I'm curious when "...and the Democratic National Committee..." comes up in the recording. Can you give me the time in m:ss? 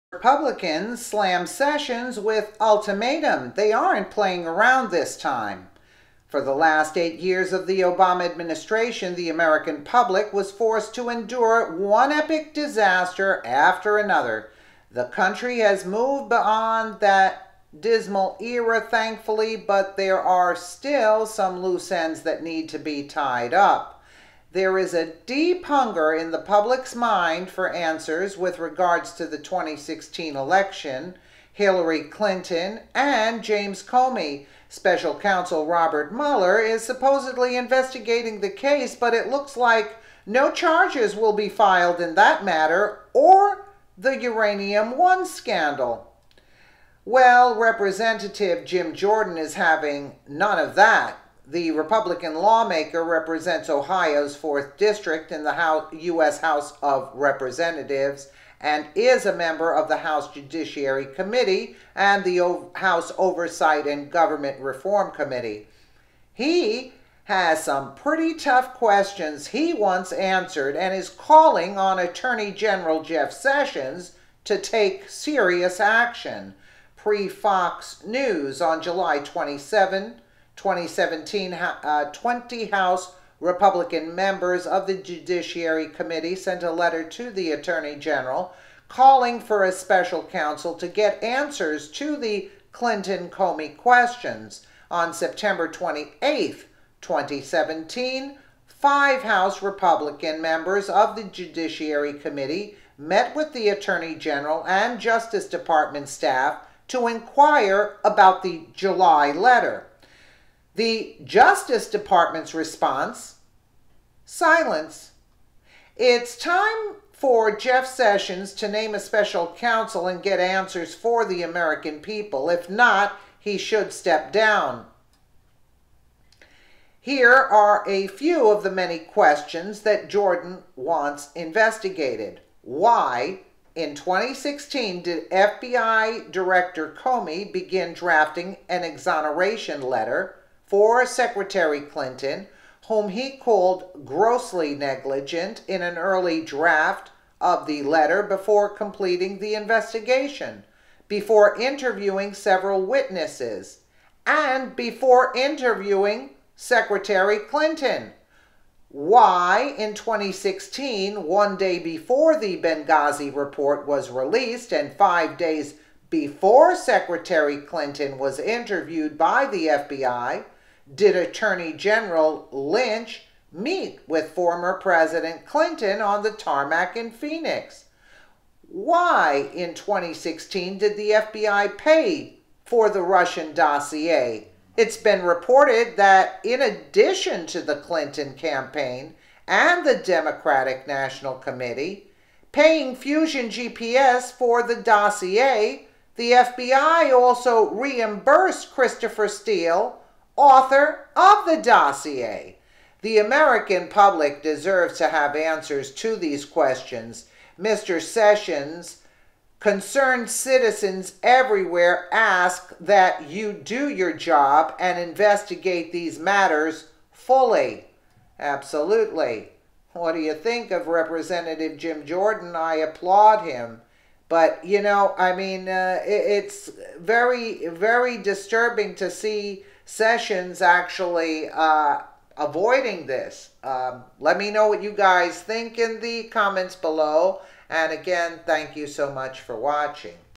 3:09.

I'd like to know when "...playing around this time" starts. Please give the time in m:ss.
0:04.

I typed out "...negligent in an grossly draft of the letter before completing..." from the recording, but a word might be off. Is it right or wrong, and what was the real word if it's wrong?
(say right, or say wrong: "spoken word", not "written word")
wrong: "early", not "grossly".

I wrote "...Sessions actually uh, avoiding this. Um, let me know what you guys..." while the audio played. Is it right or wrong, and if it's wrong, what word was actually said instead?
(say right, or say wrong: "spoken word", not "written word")
right.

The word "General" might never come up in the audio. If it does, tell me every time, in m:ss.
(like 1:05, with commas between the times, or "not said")
1:12, 1:27, 1:44, 2:51.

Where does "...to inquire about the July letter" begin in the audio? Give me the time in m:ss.
1:46.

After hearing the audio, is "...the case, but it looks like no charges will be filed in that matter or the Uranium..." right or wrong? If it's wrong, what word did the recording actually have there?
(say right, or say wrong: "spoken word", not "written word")
right.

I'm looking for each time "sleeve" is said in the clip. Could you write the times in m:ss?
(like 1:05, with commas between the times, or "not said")
not said.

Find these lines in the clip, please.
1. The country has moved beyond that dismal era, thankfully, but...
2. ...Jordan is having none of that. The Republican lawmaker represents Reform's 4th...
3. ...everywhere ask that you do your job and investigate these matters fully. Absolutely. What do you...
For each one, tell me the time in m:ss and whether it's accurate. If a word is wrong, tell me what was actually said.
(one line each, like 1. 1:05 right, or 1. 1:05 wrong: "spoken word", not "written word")
1. 0:14 right
2. 0:48 wrong: "Ohio", not "Reform"
3. 3:31 right.